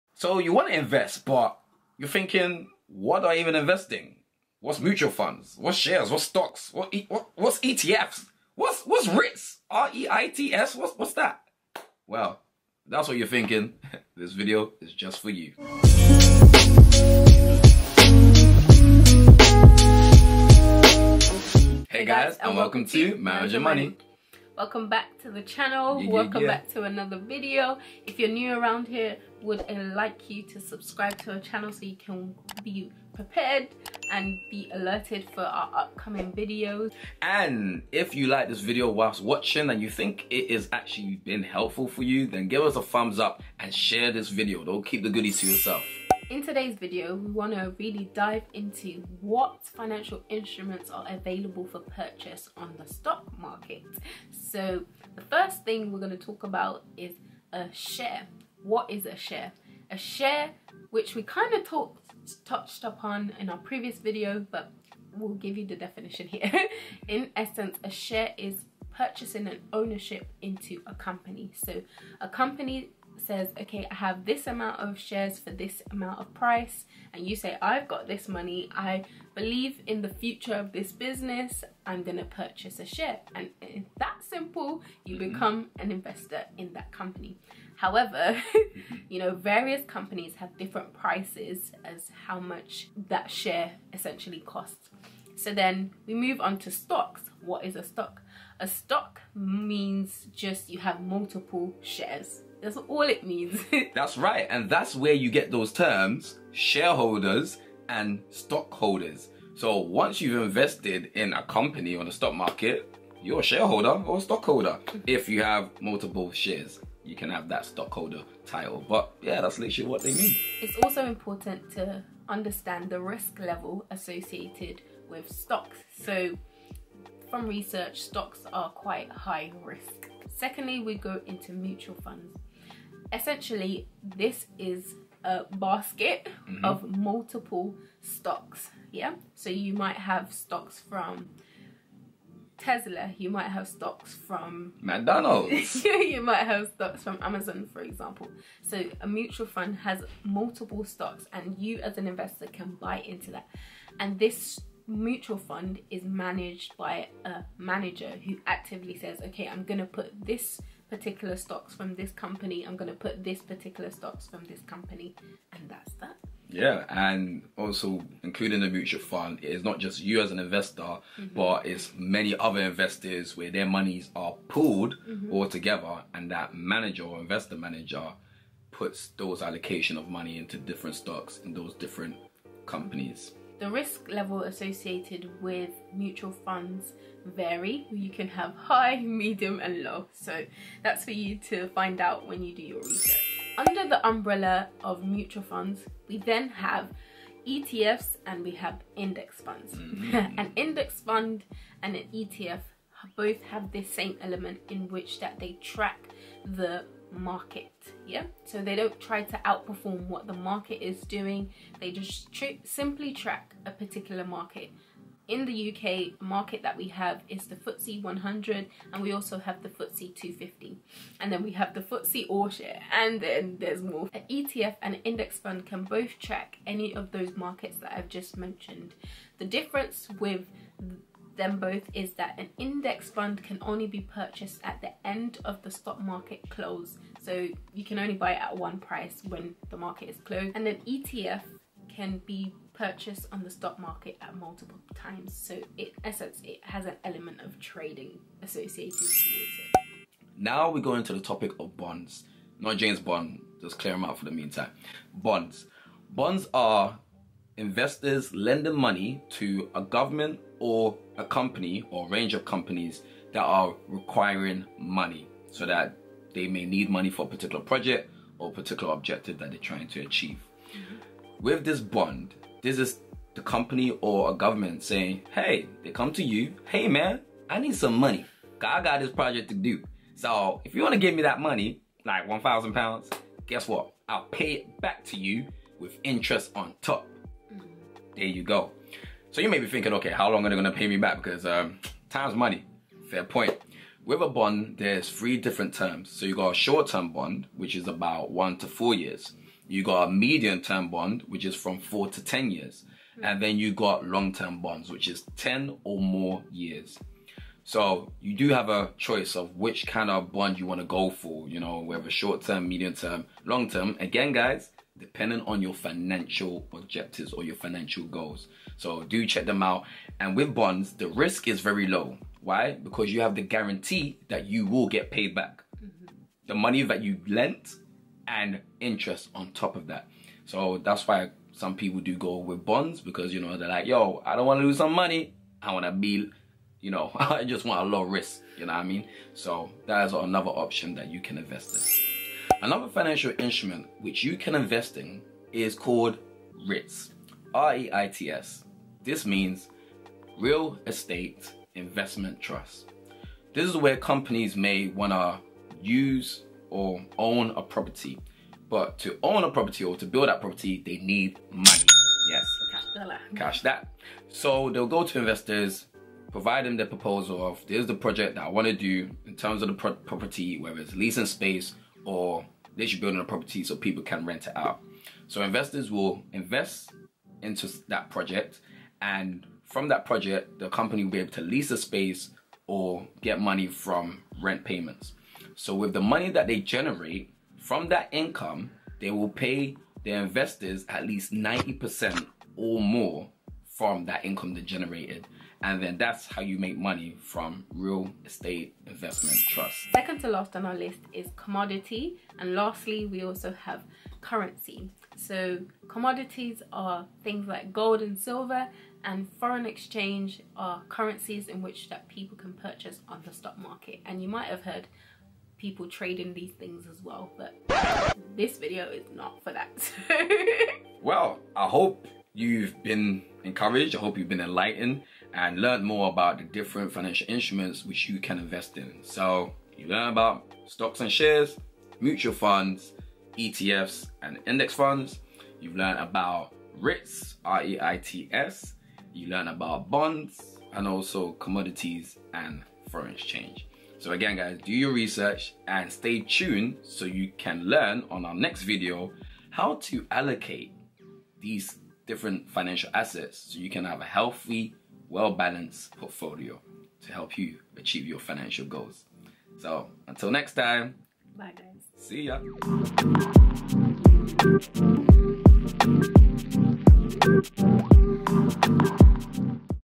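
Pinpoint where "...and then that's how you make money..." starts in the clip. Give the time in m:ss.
6:35.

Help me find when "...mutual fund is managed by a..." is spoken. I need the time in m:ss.
2:34.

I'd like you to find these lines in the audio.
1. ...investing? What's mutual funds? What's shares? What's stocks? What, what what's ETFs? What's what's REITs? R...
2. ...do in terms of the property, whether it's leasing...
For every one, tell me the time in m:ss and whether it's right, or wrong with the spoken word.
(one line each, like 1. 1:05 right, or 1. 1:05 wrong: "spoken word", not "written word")
1. 0:03 right
2. 6:08 right.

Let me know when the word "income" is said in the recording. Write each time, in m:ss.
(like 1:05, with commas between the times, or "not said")
6:28, 6:34.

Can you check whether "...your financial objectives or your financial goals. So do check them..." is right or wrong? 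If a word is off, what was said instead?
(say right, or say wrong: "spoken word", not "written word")
right.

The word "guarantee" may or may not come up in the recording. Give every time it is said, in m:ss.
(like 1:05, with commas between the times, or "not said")
5:23.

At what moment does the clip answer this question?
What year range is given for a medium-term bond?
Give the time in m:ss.
5:01.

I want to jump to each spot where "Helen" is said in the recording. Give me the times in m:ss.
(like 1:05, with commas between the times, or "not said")
not said.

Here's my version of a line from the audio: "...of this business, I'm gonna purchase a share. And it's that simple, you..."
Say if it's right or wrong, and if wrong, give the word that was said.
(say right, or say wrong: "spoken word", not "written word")
right.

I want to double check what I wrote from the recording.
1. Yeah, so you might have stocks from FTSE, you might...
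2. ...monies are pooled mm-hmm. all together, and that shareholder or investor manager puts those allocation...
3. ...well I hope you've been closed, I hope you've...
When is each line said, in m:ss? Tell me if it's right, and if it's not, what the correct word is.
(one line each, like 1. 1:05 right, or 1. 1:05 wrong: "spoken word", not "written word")
1. 2:18 wrong: "Tesla", not "FTSE"
2. 2:53 wrong: "manager", not "shareholder"
3. 7:01 wrong: "encouraged", not "closed".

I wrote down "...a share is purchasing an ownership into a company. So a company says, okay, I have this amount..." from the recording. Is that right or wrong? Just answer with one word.
right.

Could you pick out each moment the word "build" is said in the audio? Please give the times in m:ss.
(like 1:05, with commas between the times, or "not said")
6:00, 6:13.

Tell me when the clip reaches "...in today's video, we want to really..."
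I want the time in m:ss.
0:46.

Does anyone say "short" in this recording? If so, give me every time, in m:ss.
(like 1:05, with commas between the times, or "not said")
4:56, 5:12.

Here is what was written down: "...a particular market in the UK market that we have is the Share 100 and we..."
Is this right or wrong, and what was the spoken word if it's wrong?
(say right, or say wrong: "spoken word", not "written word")
wrong: "FTSE", not "Share".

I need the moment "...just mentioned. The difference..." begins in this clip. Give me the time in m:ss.
3:48.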